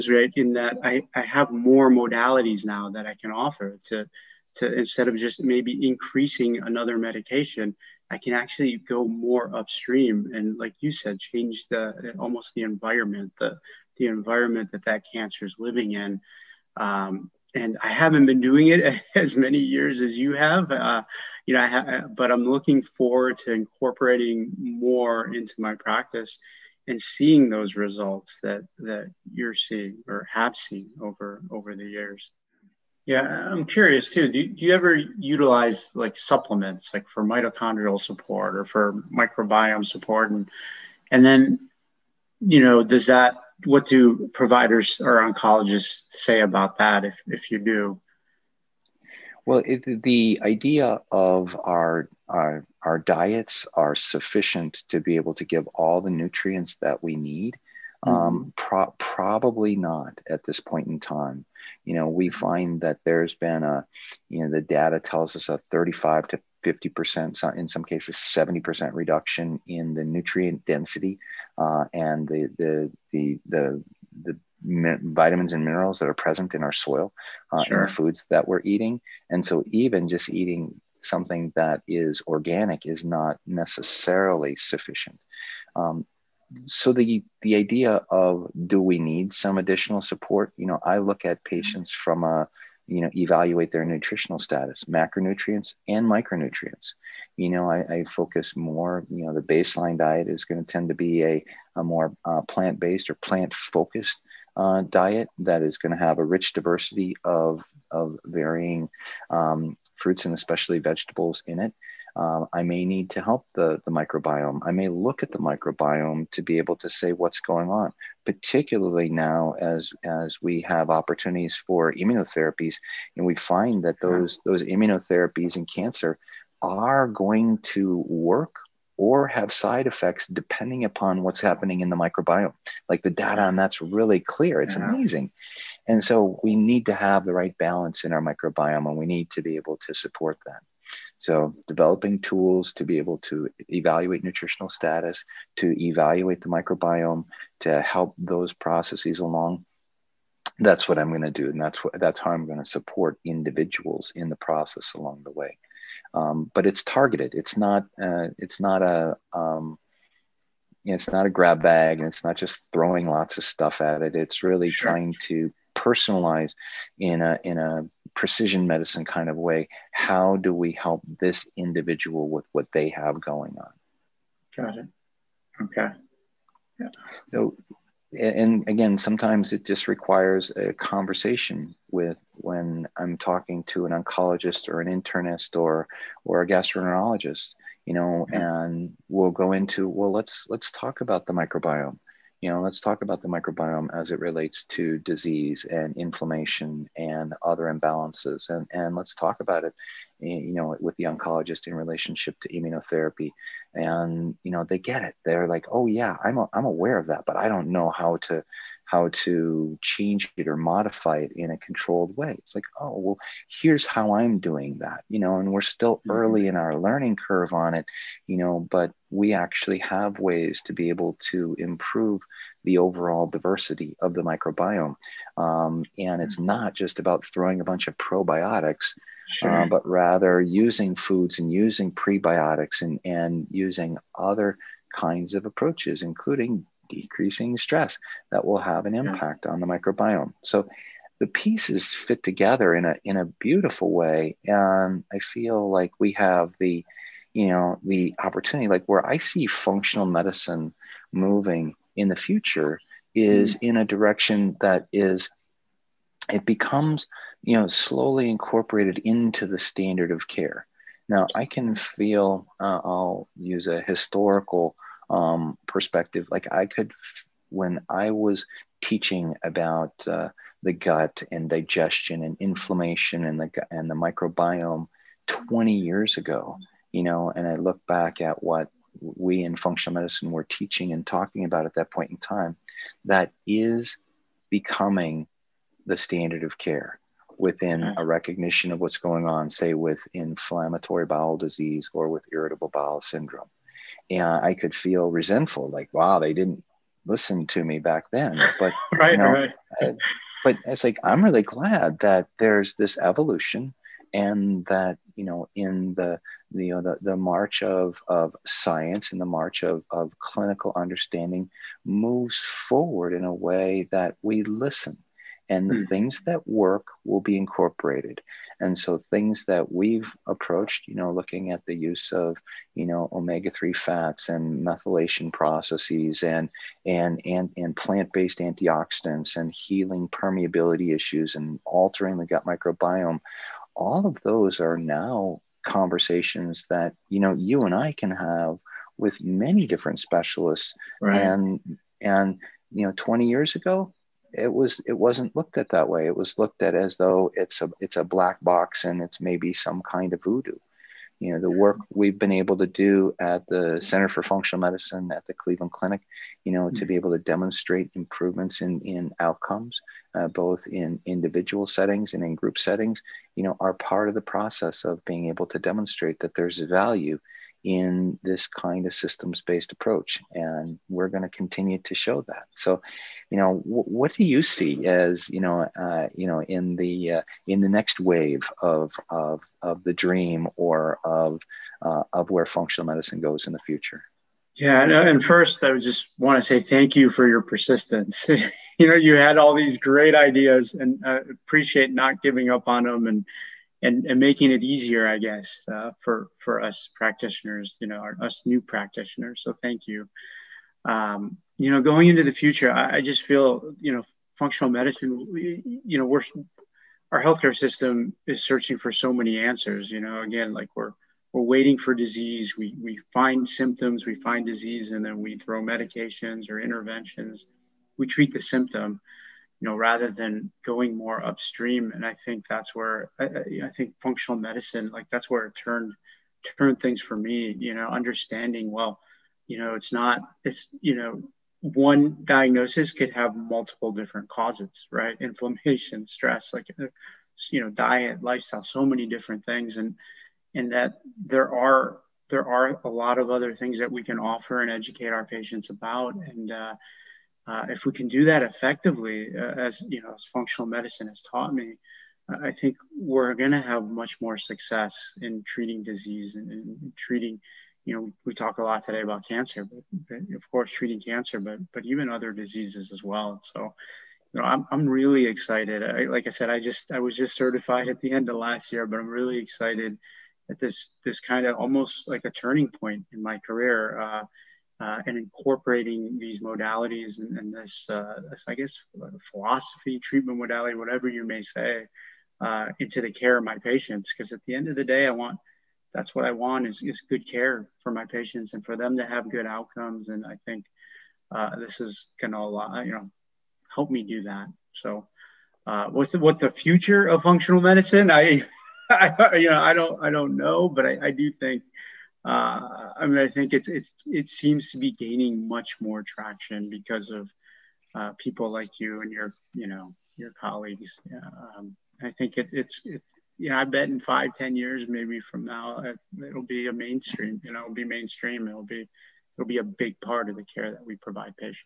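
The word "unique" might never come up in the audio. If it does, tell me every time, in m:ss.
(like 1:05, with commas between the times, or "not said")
not said.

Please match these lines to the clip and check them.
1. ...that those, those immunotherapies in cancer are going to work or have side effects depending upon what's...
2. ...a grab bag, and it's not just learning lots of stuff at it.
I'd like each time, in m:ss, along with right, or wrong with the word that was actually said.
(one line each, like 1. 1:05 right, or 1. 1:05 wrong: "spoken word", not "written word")
1. 2:03 right
2. 2:41 wrong: "throwing", not "learning".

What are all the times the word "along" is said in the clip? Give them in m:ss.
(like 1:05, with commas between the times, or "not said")
2:29, 2:34.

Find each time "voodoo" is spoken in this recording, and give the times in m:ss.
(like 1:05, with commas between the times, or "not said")
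5:50.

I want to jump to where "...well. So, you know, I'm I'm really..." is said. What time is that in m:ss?
7:43.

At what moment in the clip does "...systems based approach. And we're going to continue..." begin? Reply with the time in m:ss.
6:08.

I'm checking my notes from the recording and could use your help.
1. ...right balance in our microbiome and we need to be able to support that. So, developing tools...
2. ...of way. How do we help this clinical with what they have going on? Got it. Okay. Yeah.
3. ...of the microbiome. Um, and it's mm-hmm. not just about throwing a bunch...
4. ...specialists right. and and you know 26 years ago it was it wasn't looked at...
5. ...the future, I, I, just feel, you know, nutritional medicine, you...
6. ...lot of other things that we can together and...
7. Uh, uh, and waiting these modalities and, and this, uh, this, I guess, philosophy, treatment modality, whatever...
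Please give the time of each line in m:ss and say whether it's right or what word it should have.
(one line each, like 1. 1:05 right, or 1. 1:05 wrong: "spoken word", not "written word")
1. 2:17 right
2. 2:49 wrong: "individual", not "clinical"
3. 3:44 right
4. 5:40 wrong: "20", not "26"
5. 6:42 wrong: "functional", not "nutritional"
6. 7:22 wrong: "offer", not "together"
7. 7:53 wrong: "incorporating", not "waiting".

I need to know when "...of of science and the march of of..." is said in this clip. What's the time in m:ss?
5:07.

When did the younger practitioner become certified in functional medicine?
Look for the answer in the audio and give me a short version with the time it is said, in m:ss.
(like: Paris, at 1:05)
End of last year, at 7:48.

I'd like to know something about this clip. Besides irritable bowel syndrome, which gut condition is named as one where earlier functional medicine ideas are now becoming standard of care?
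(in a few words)
Inflammatory bowel disease.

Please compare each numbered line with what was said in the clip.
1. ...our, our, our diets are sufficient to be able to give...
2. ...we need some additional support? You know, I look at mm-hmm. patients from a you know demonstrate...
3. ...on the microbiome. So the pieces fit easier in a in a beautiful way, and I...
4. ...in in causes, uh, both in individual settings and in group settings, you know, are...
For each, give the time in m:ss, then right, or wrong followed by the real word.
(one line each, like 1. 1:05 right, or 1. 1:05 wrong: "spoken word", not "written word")
1. 0:51 right
2. 1:28 wrong: "evaluate", not "demonstrate"
3. 3:59 wrong: "together", not "easier"
4. 5:58 wrong: "outcomes", not "causes".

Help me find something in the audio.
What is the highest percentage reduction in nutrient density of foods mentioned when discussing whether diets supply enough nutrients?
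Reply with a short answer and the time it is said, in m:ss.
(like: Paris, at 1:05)
70%, at 1:08.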